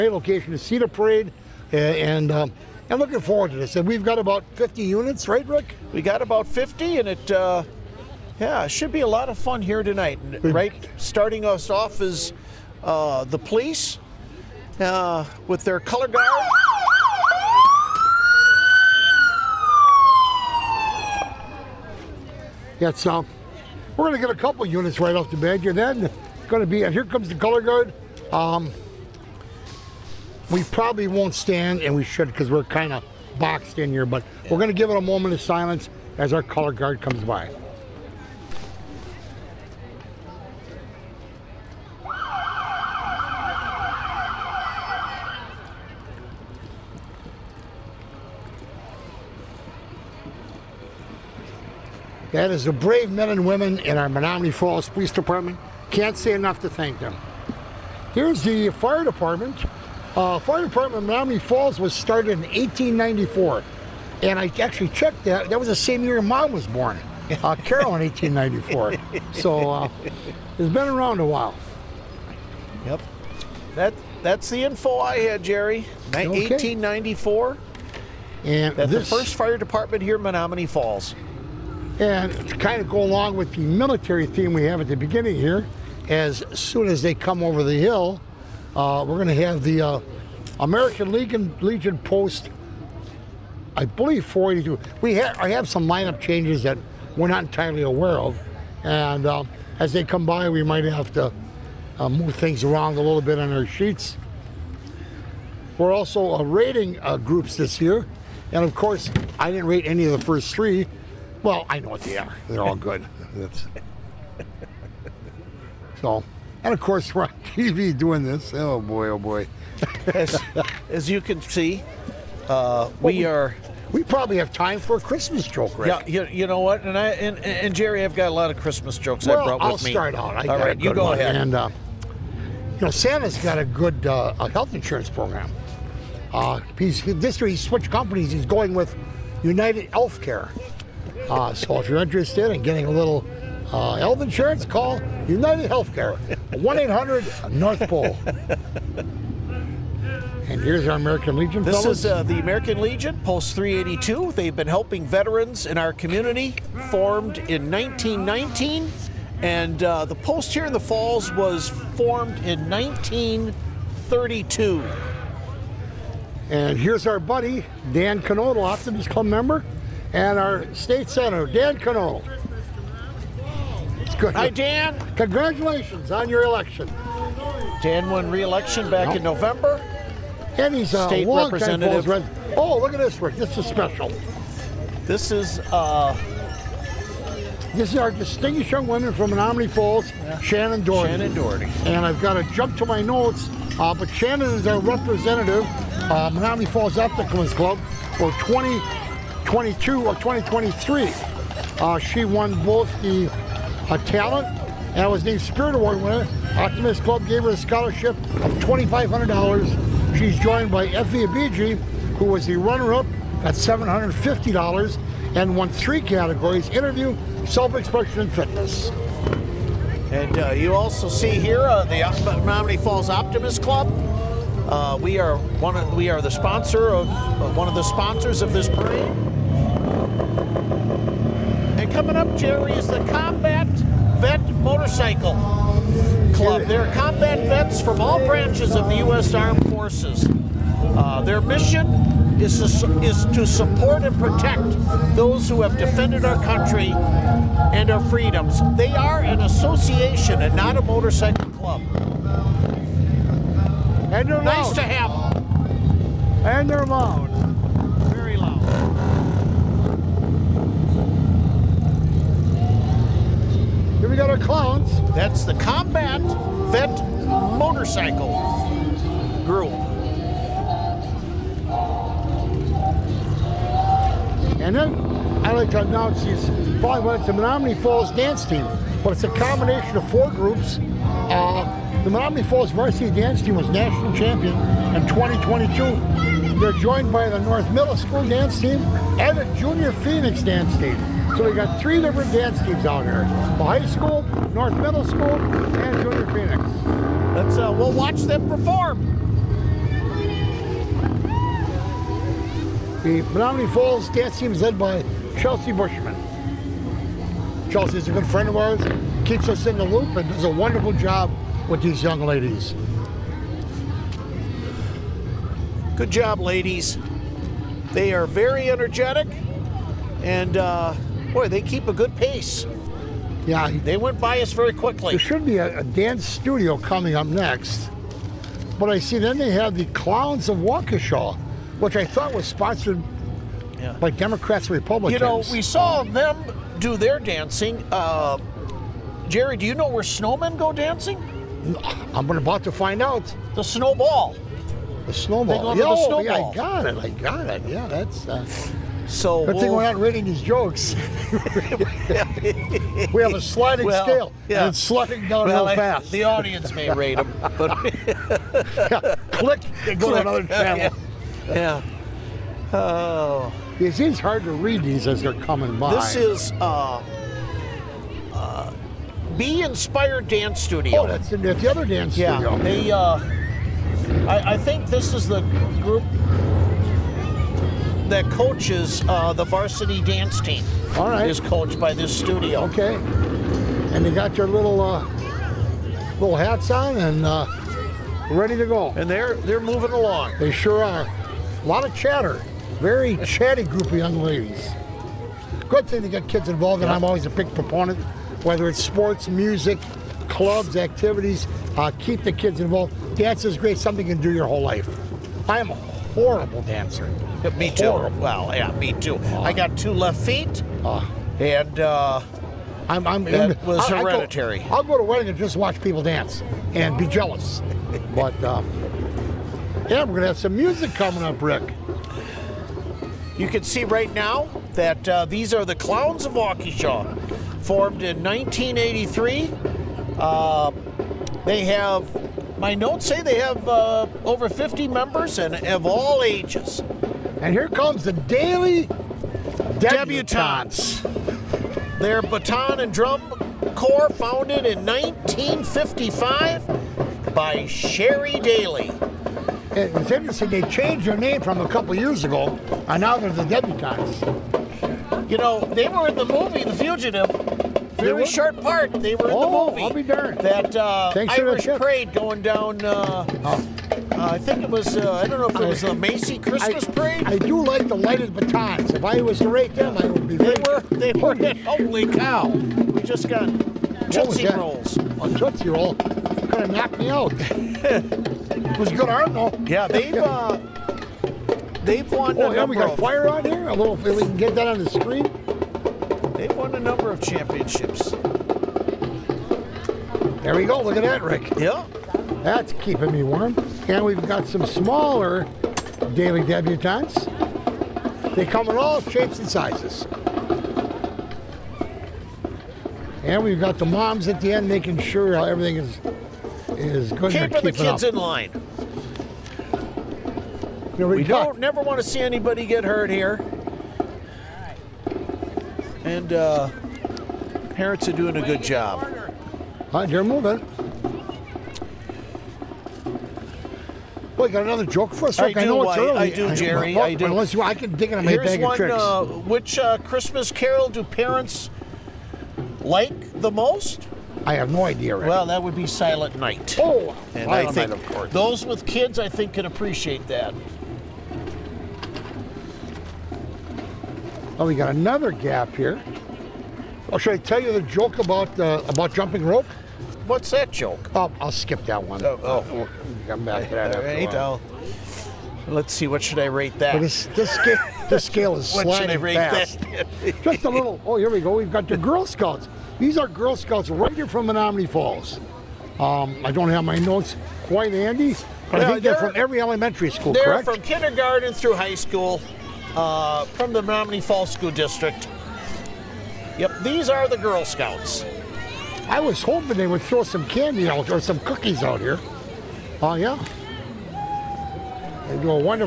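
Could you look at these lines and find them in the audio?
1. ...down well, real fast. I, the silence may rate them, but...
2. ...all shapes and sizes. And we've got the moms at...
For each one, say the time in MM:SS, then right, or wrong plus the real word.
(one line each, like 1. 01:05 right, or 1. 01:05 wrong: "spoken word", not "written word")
1. 05:55 wrong: "audience", not "silence"
2. 08:18 right.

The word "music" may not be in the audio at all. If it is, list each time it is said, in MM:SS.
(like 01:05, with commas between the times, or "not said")
06:39, 07:00.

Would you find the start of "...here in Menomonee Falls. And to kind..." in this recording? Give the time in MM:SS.
01:20.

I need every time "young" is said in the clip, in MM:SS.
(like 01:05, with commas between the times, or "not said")
03:08, 05:12, 06:33.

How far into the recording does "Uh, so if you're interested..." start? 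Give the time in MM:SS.
02:21.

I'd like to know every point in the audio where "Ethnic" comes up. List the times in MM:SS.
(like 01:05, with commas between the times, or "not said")
03:16.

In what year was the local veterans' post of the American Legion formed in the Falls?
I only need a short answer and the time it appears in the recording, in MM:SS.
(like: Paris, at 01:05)
1932, at 02:42.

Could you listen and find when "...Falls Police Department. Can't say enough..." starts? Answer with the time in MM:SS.
00:54.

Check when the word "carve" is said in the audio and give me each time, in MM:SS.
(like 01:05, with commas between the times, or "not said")
not said.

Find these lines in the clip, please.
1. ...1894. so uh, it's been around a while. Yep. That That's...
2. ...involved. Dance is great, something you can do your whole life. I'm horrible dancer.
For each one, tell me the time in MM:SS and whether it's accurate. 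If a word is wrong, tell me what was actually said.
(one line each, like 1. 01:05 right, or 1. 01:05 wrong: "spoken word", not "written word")
1. 01:08 right
2. 06:42 right.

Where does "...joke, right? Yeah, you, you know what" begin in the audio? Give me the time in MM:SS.
02:05.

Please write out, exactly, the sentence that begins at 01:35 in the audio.
We ha I have some lineup changes that we're not entirely aware of.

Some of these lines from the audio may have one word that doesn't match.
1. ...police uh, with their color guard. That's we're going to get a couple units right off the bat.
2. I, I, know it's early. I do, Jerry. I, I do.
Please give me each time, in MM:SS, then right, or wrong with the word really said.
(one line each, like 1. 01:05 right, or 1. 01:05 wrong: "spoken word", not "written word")
1. 00:13 right
2. 08:45 right.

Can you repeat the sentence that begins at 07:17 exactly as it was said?
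And here comes the Daily Debutantes.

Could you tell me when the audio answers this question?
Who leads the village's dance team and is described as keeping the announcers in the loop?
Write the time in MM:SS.
05:05.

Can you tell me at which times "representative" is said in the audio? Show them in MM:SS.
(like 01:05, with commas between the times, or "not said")
03:01, 03:14.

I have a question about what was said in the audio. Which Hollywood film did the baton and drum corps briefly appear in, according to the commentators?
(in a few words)
The Fugitive.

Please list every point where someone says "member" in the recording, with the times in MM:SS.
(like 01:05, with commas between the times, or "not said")
02:49, 07:14.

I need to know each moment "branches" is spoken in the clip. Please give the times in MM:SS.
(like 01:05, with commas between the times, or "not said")
03:58.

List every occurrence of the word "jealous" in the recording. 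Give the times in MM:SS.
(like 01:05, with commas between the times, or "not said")
06:57.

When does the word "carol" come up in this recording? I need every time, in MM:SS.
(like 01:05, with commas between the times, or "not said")
01:07, 08:50.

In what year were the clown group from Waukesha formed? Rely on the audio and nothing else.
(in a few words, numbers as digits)
1983.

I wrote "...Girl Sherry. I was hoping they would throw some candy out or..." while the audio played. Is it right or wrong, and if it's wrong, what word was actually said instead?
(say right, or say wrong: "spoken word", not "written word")
wrong: "Scouts", not "Sherry".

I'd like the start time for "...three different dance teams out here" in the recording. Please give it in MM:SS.
04:51.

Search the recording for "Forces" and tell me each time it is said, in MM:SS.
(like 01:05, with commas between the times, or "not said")
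03:59.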